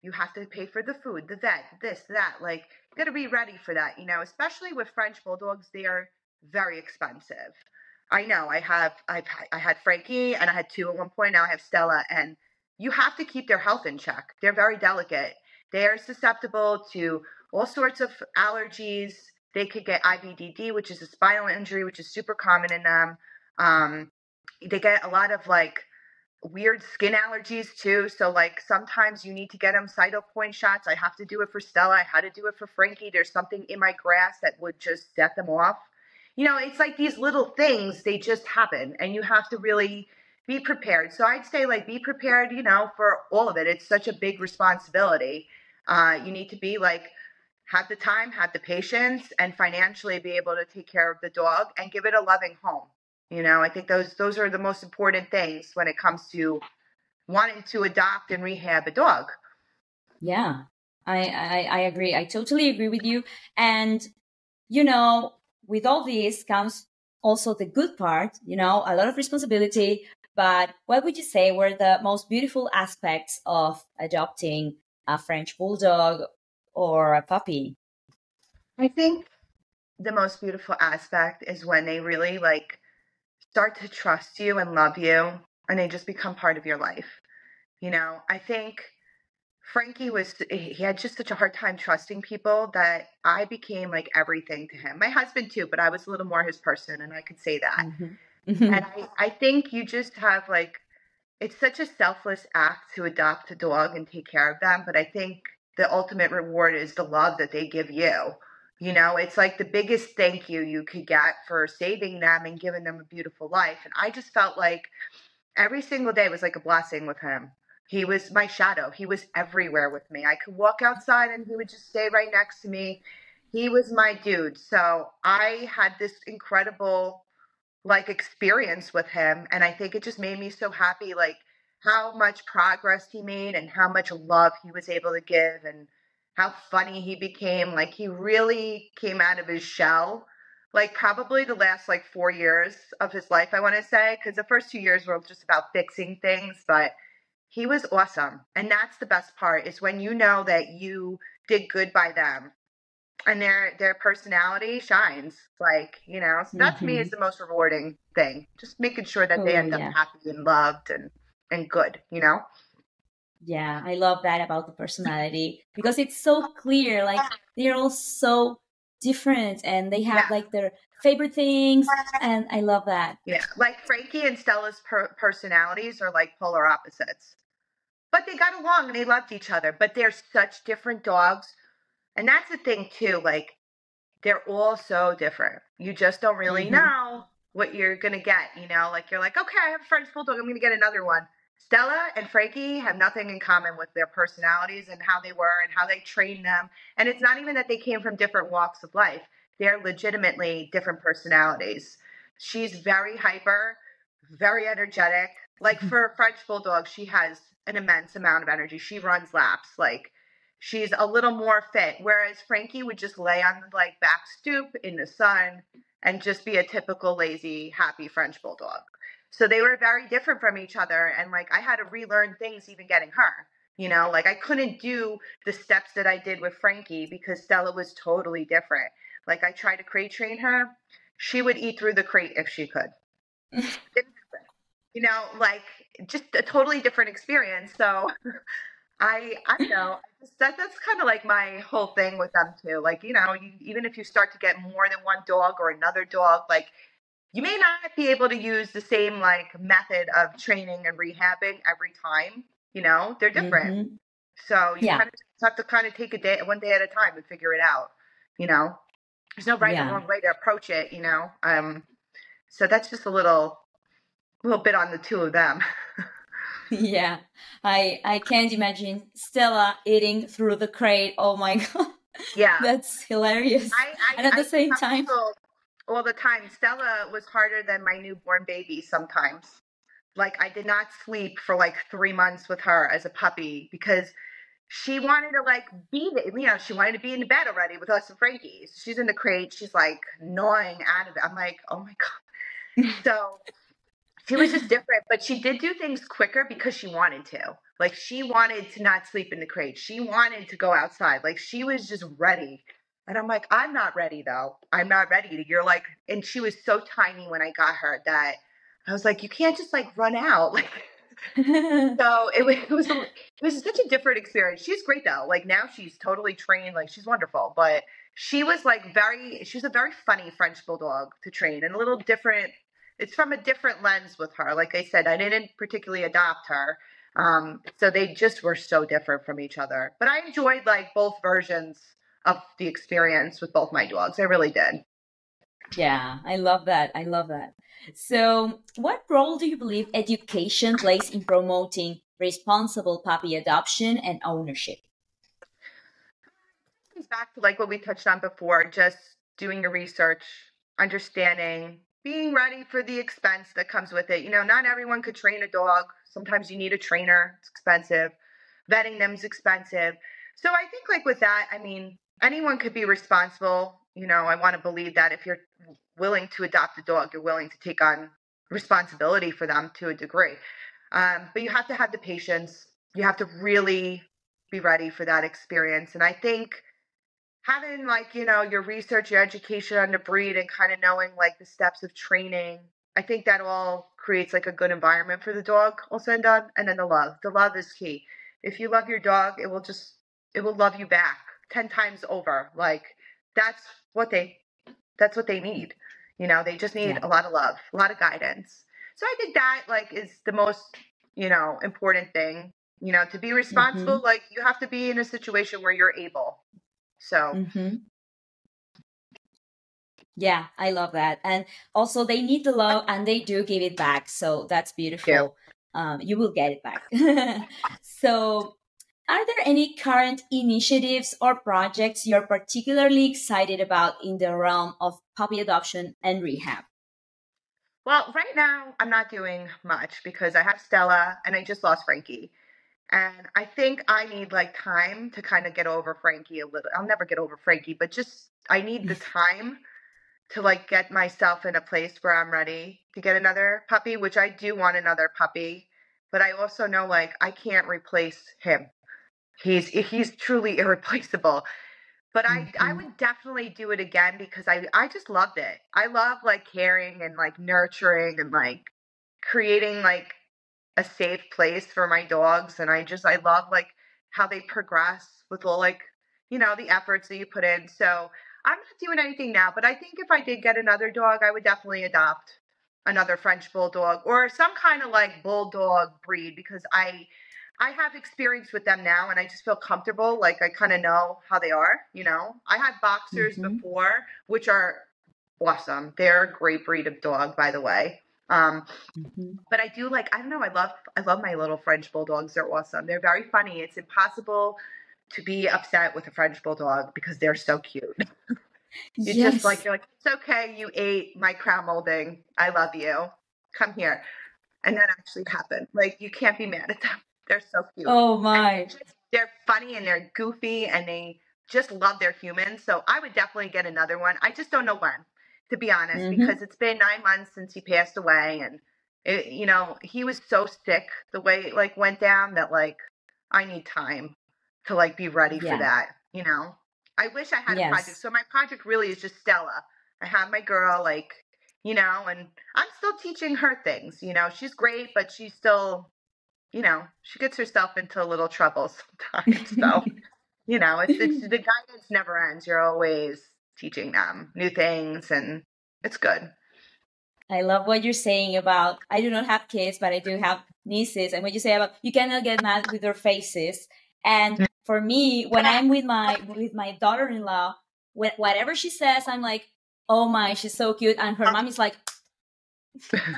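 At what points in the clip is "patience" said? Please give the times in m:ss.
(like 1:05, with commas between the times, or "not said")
0:48, 6:11.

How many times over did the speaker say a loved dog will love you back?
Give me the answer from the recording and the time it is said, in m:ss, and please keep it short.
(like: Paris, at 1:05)
10 times, at 6:31.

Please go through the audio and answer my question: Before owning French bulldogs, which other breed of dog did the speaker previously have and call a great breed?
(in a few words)
Boxers.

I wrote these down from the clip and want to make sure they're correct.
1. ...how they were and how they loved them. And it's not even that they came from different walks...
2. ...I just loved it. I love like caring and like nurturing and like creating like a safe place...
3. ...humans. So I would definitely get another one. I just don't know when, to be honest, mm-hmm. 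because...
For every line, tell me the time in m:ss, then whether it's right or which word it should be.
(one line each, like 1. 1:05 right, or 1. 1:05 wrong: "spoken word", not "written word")
1. 3:15 wrong: "trained", not "loved"
2. 7:34 right
3. 8:32 right.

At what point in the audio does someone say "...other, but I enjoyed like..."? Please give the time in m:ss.
5:29.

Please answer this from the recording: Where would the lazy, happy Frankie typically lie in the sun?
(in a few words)
Back stoop.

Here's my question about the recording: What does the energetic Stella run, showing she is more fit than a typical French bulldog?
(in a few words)
Laps.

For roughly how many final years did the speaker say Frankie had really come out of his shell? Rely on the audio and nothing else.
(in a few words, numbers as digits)
4 years.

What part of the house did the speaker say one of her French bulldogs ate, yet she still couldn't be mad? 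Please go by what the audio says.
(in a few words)
Crown molding.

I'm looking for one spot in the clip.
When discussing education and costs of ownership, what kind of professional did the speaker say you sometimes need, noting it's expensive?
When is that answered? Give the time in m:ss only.
5:56.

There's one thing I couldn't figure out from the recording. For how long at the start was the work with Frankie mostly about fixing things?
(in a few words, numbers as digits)
2 years.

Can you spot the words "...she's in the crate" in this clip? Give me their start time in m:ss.
4:48.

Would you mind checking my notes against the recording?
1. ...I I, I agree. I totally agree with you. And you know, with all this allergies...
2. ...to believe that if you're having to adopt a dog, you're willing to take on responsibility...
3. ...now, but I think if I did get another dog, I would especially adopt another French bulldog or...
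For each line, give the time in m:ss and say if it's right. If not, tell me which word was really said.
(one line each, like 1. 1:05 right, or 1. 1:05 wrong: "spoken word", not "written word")
1. 1:01 wrong: "comes", not "allergies"
2. 6:04 wrong: "willing", not "having"
3. 7:49 wrong: "definitely", not "especially".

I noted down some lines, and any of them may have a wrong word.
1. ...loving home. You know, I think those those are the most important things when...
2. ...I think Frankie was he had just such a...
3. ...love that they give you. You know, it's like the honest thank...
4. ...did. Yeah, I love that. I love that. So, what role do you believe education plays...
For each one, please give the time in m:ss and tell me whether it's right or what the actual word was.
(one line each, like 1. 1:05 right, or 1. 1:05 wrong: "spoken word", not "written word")
1. 0:52 right
2. 1:28 right
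3. 1:47 wrong: "biggest", not "honest"
4. 5:34 right.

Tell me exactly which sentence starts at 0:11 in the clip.
Now I have Stella, and you have to keep their health in check.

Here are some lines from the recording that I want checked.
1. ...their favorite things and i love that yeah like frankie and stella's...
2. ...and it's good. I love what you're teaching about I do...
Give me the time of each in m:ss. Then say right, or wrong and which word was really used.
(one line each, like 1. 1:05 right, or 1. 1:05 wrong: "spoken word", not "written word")
1. 2:50 right
2. 9:05 wrong: "saying", not "teaching".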